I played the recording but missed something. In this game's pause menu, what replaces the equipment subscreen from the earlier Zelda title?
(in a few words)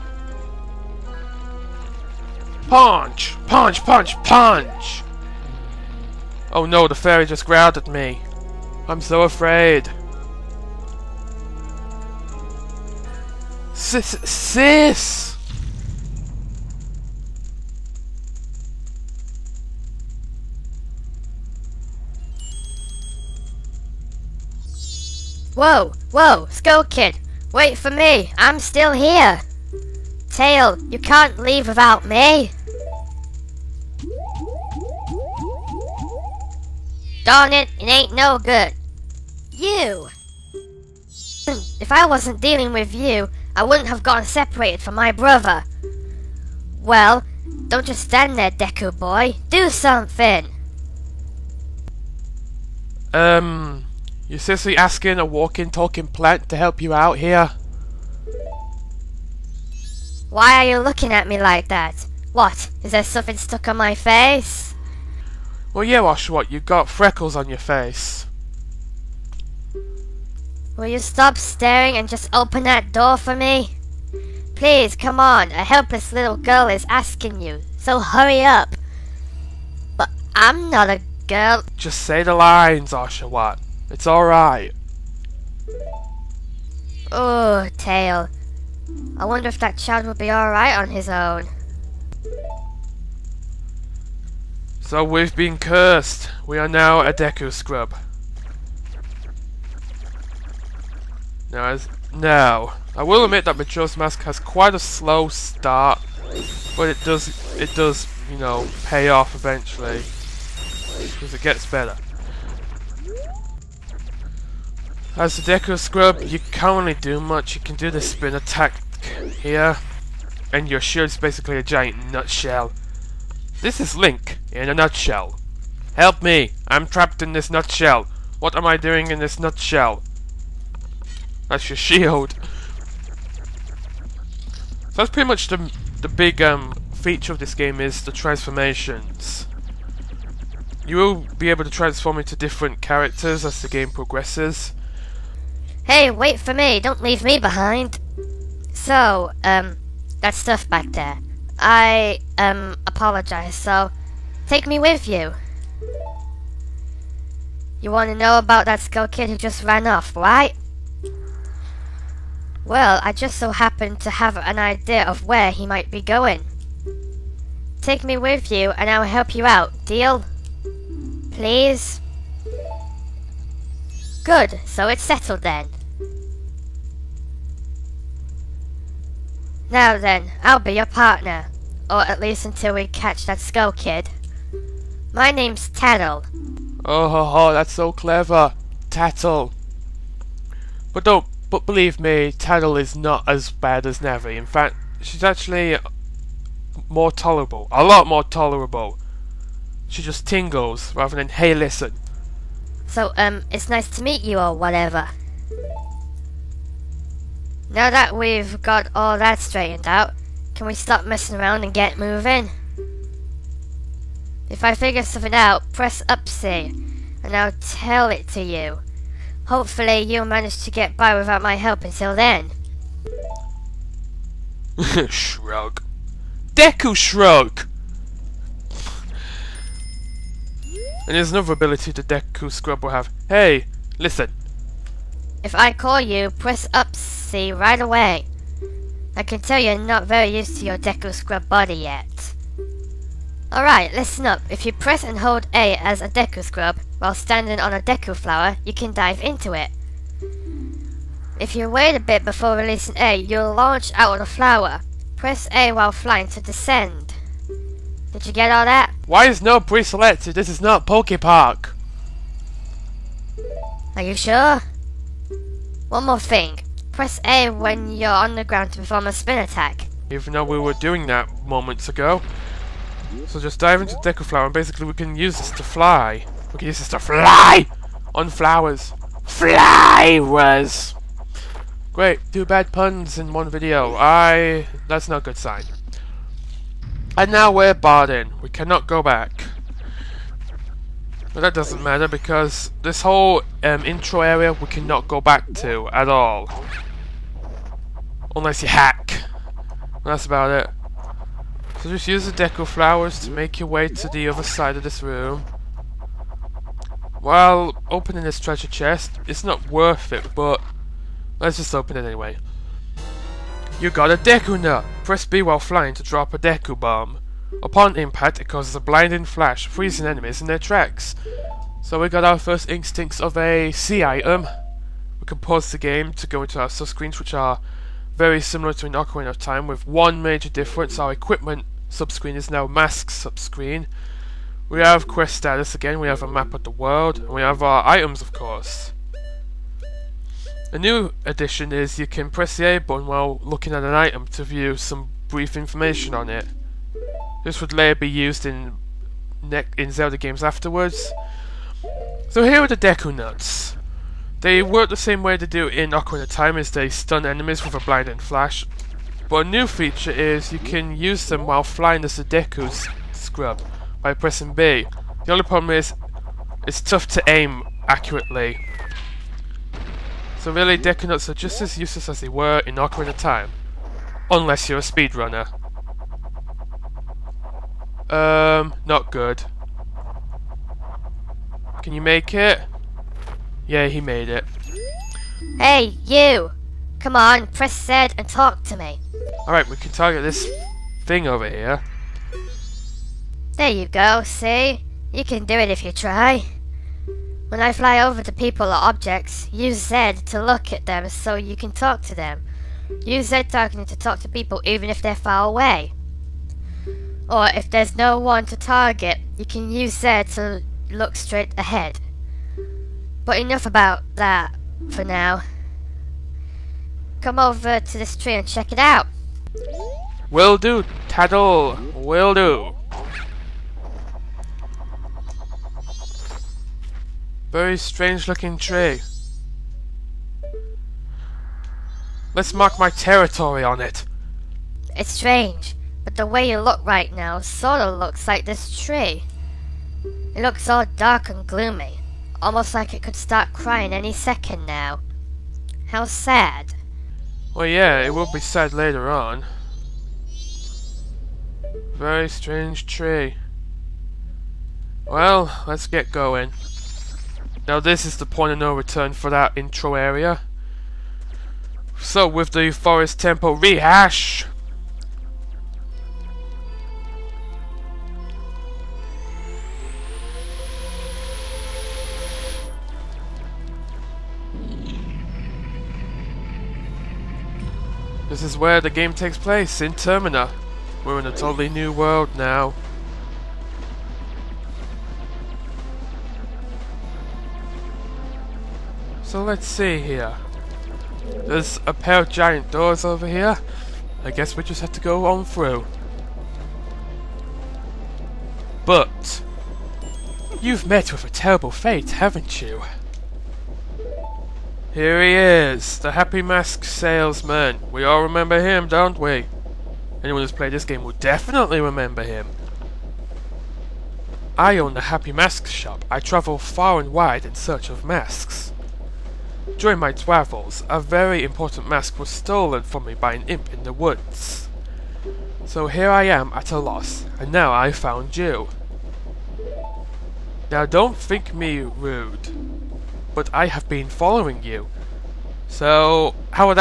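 mask subscreen.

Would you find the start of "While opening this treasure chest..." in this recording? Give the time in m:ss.
5:07.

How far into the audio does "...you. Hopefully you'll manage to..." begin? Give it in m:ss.
3:38.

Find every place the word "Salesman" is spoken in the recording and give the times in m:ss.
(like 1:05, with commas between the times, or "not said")
8:26.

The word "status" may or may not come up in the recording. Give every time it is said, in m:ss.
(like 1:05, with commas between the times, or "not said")
5:35.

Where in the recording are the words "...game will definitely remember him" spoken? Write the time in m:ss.
8:30.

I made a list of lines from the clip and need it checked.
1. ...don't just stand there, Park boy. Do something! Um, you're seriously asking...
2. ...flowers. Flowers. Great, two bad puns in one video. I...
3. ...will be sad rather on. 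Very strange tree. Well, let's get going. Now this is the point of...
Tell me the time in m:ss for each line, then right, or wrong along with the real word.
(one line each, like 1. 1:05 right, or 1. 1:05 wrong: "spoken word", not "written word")
1. 0:47 wrong: "Deku", not "Park"
2. 4:38 right
3. 7:28 wrong: "later", not "rather".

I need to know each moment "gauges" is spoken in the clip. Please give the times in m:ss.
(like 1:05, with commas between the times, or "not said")
not said.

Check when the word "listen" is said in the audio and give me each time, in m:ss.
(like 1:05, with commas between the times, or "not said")
3:21, 3:53, 4:03.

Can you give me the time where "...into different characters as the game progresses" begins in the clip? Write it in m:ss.
2:22.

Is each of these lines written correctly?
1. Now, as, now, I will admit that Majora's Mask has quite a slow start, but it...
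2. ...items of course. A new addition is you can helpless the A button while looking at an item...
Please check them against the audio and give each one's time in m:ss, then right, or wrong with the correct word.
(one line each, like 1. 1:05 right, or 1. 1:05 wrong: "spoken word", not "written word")
1. 1:41 right
2. 5:37 wrong: "press", not "helpless".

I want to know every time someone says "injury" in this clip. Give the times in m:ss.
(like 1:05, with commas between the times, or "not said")
not said.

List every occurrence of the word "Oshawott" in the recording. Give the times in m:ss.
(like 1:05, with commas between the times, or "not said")
1:05, 1:22.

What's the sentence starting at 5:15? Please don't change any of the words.
Press B while flying to drop a Deku Bomb.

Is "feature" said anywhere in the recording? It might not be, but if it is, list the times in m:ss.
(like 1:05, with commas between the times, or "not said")
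2:16, 5:59.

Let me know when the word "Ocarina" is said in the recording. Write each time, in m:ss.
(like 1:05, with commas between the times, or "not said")
5:28, 5:55, 6:12.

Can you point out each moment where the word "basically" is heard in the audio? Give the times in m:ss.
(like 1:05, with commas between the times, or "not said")
2:01, 4:34.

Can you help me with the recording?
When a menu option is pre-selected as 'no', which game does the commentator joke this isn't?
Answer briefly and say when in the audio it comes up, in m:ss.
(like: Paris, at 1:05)
Poke Park, at 4:20.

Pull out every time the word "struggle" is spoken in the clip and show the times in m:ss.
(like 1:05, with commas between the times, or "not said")
not said.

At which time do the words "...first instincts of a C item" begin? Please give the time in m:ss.
5:22.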